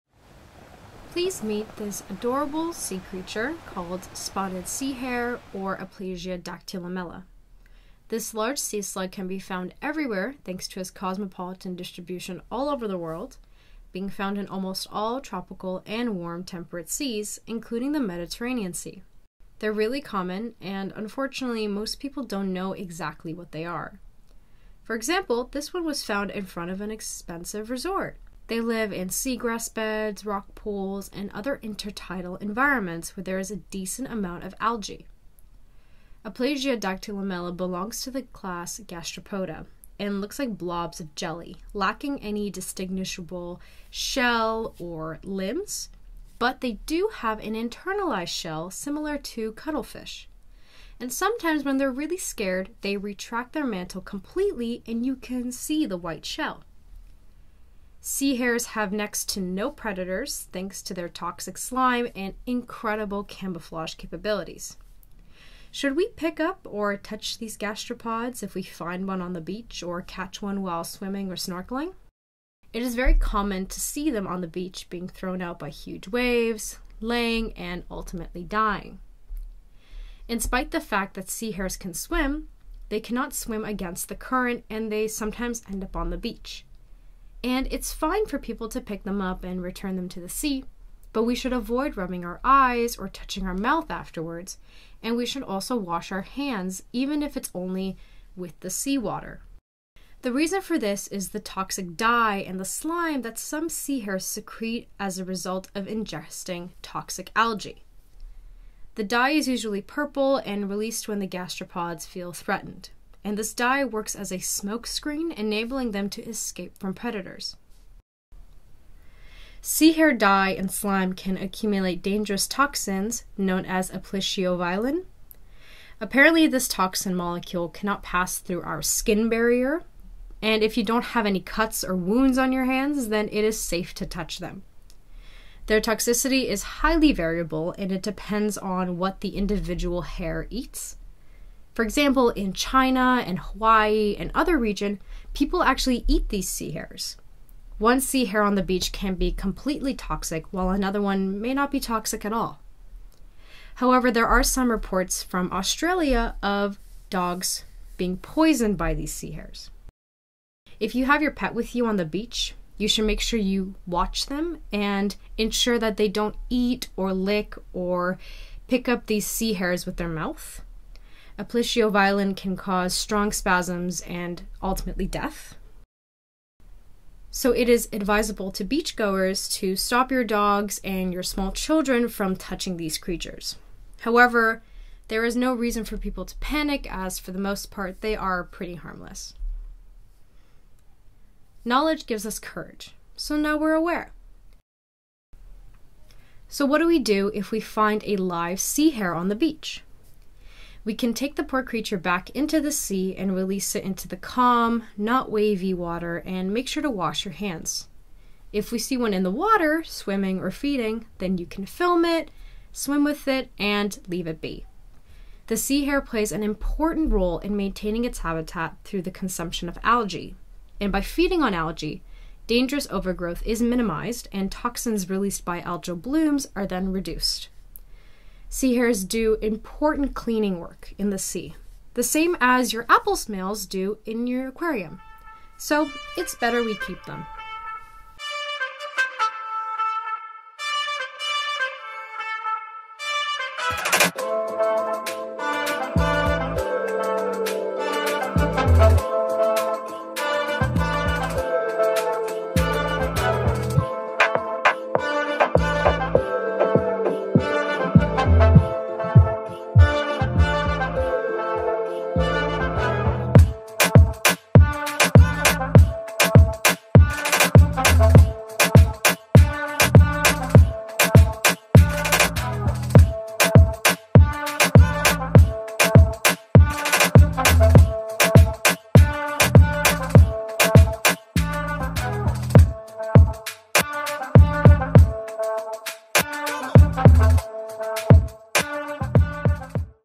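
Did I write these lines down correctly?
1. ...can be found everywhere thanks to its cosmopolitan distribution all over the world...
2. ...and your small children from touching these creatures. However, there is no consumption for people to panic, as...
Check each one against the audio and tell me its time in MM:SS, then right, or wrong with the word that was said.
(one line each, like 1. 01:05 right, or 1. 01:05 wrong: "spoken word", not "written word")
1. 00:09 right
2. 03:00 wrong: "reason", not "consumption".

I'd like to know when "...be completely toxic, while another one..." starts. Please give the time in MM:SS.
02:29.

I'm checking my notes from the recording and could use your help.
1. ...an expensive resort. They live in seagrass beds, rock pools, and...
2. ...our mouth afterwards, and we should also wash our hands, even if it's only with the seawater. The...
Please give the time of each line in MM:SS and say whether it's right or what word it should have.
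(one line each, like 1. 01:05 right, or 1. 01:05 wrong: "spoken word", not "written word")
1. 00:26 right
2. 01:33 right.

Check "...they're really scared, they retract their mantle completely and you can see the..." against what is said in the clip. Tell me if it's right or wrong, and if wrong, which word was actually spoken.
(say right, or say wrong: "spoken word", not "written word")
right.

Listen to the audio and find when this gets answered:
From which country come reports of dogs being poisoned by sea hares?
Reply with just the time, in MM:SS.
02:35.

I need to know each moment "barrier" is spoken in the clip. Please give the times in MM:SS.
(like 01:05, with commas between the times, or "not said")
02:09.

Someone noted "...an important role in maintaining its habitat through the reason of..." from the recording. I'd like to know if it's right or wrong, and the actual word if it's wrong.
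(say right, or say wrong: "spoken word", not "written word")
wrong: "consumption", not "reason".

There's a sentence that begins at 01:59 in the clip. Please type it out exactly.
Sea hare dye and slime can accumulate dangerous toxins known as aplysioviolin.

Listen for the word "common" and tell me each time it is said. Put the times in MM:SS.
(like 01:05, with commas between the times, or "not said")
00:19, 01:13.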